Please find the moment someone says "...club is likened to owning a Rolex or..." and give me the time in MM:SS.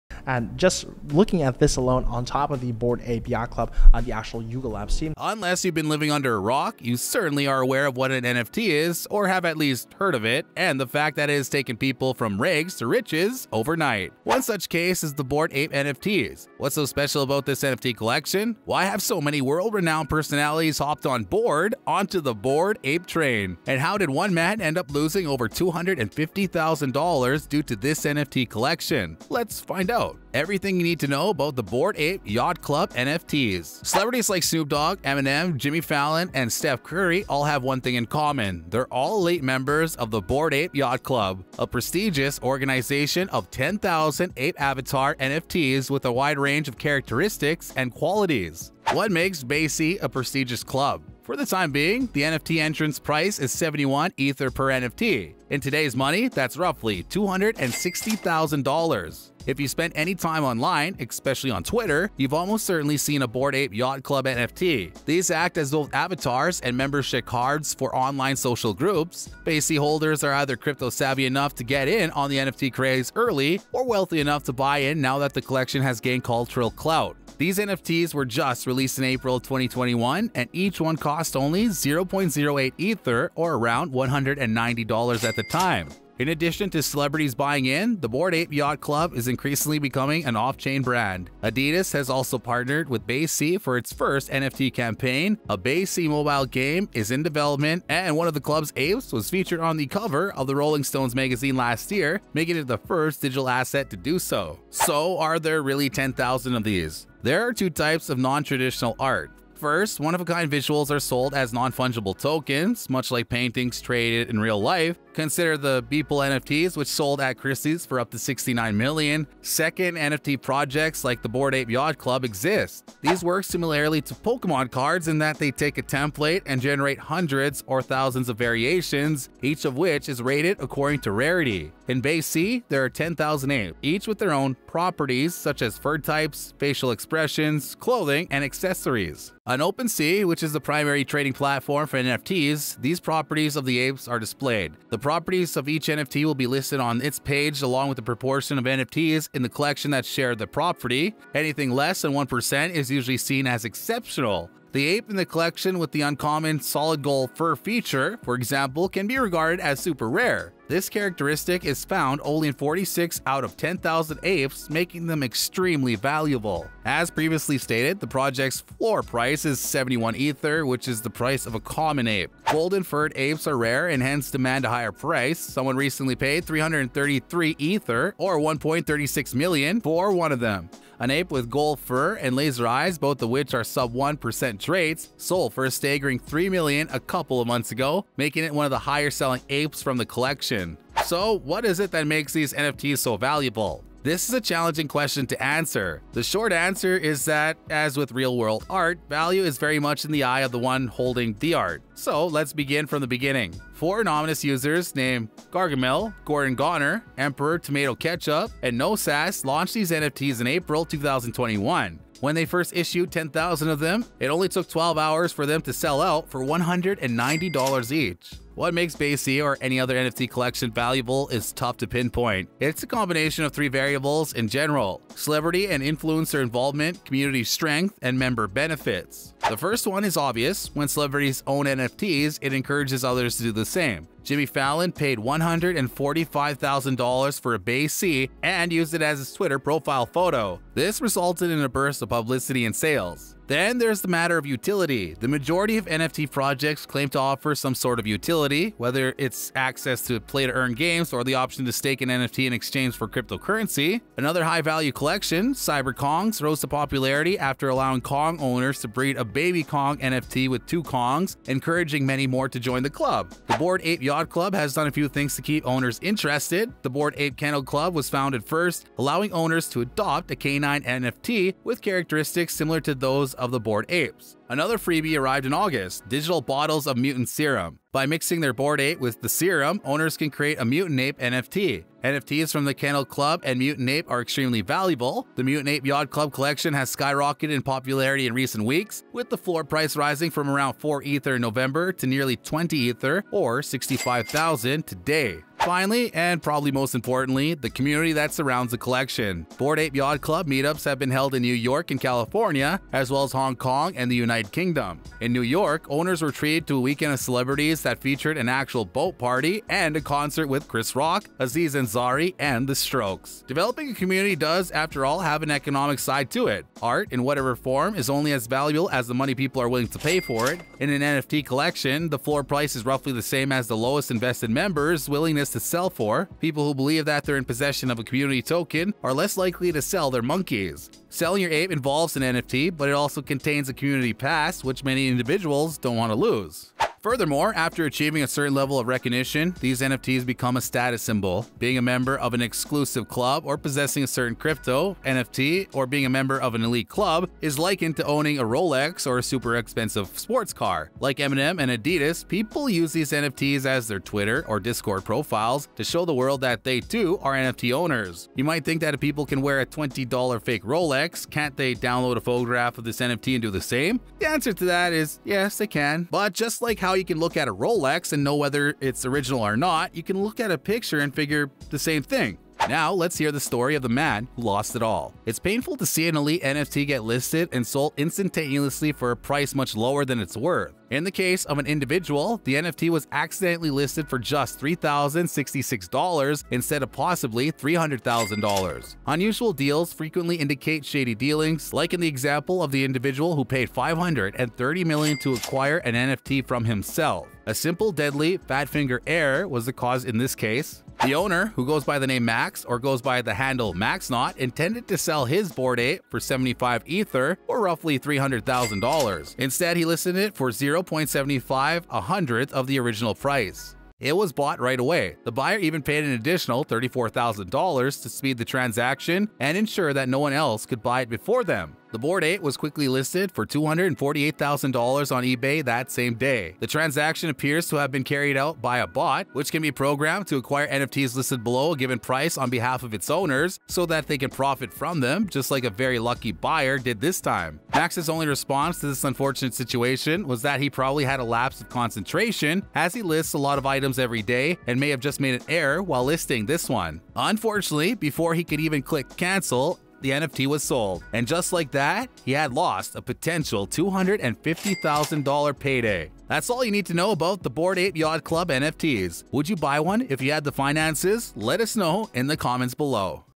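05:46.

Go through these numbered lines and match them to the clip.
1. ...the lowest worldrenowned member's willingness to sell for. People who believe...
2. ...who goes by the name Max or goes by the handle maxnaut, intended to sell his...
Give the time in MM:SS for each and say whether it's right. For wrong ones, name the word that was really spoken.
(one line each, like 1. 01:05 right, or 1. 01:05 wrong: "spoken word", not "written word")
1. 05:23 wrong: "invested", not "worldrenowned"
2. 06:41 right.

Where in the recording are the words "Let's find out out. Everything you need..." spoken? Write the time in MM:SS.
00:29.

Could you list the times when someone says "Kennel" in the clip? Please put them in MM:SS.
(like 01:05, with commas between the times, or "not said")
04:27, 04:42.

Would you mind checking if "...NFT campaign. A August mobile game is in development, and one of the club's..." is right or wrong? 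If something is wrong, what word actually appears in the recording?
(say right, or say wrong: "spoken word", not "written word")
wrong: "BAYC", not "August".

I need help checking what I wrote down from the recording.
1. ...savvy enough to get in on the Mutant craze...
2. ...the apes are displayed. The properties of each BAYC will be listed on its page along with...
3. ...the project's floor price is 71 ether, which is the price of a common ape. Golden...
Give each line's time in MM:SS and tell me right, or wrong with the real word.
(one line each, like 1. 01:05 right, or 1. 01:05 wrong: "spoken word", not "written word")
1. 01:10 wrong: "NFT", not "Mutant"
2. 02:23 wrong: "NFT", not "BAYC"
3. 02:47 right.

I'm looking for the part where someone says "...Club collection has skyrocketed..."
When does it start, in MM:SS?
04:46.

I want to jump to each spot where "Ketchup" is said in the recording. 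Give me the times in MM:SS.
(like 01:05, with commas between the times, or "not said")
03:27.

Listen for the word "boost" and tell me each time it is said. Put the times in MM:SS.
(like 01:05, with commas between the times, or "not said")
not said.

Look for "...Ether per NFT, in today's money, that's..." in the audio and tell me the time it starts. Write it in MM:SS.
00:54.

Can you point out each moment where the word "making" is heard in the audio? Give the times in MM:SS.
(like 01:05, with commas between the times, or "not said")
01:42, 02:44, 03:08.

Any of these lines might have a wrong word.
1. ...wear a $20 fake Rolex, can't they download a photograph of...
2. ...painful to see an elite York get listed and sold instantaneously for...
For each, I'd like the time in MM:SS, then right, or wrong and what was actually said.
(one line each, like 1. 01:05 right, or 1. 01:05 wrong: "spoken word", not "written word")
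1. 05:59 right
2. 06:15 wrong: "NFT", not "York".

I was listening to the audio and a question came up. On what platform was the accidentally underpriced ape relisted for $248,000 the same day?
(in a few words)
eBay.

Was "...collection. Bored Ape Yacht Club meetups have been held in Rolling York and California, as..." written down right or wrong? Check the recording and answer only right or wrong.
wrong.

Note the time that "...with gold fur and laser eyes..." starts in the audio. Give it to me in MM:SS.
03:01.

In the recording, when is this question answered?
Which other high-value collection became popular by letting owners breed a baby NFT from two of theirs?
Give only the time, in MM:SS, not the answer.
04:15.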